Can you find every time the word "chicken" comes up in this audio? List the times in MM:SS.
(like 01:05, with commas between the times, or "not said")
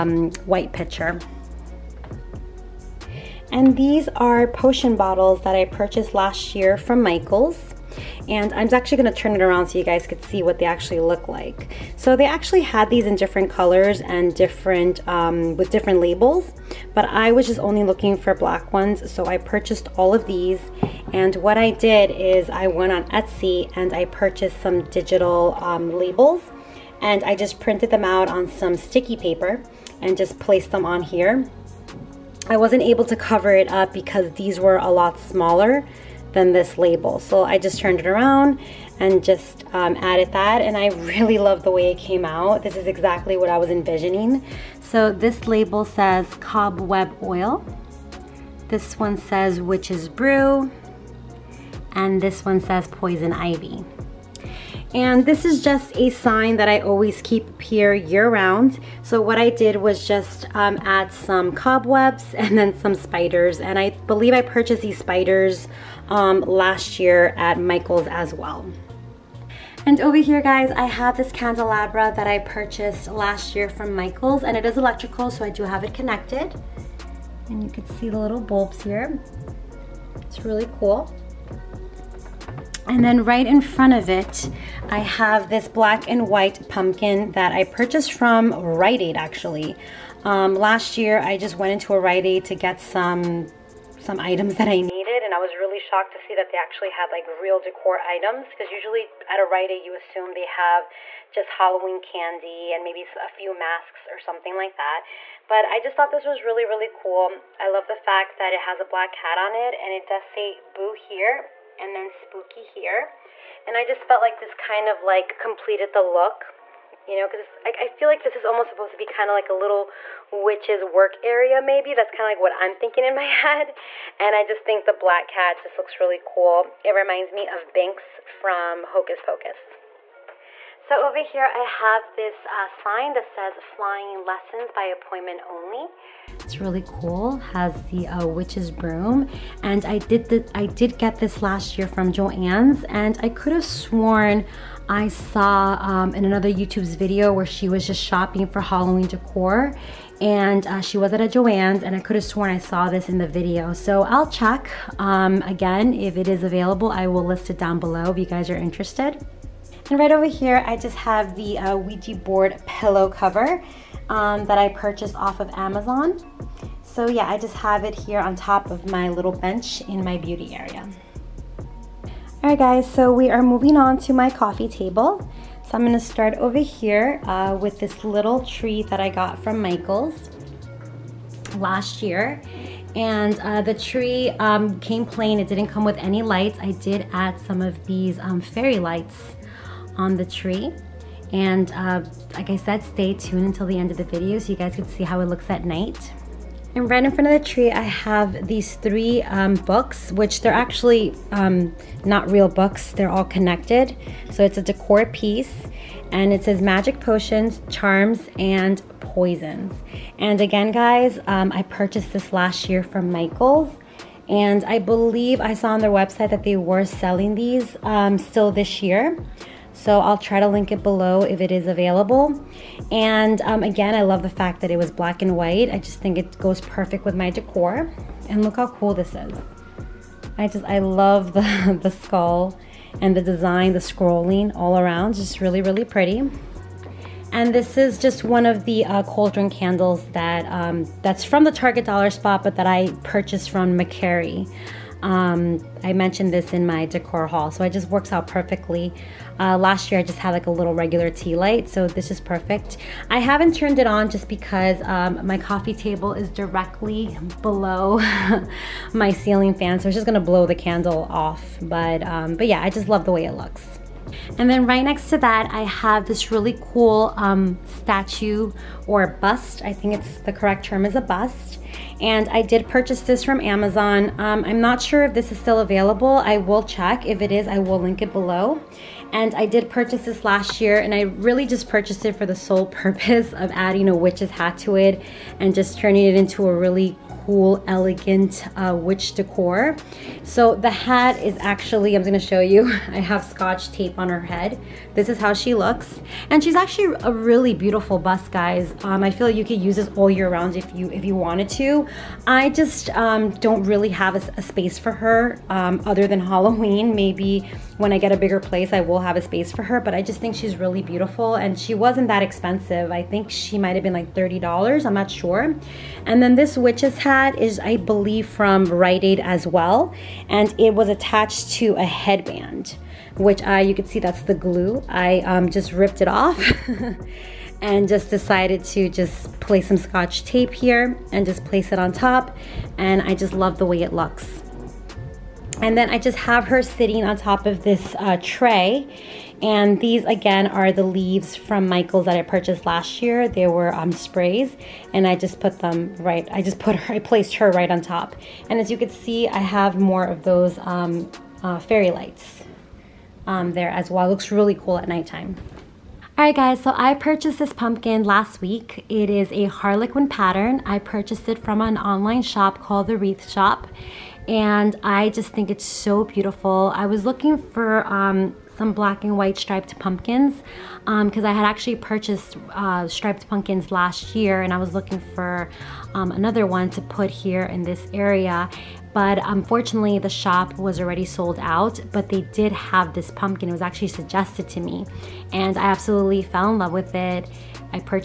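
not said.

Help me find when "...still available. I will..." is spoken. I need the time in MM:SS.
04:35.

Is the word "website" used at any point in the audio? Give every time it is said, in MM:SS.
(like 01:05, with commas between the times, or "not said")
03:35.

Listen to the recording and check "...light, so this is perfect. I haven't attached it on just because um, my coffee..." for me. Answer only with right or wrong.
wrong.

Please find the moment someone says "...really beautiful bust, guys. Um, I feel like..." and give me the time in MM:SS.
04:57.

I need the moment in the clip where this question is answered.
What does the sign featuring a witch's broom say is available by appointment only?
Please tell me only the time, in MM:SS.
02:13.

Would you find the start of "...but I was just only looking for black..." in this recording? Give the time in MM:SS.
00:16.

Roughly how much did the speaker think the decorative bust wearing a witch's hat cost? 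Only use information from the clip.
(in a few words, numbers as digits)
$30.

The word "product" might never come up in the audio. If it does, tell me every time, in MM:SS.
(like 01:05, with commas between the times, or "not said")
not said.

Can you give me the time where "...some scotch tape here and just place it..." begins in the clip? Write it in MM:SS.
05:29.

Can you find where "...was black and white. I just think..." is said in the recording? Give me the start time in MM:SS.
03:44.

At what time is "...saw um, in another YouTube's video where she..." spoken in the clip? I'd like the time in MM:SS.
02:25.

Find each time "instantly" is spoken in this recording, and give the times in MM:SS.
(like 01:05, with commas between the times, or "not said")
not said.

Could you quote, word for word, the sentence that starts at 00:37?
So I just turned it around and just um, added that and I really love the way it came out.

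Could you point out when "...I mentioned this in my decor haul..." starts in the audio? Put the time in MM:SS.
04:05.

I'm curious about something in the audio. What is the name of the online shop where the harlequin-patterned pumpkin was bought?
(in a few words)
The Wreath Shop.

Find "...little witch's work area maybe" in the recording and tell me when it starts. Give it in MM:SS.
01:59.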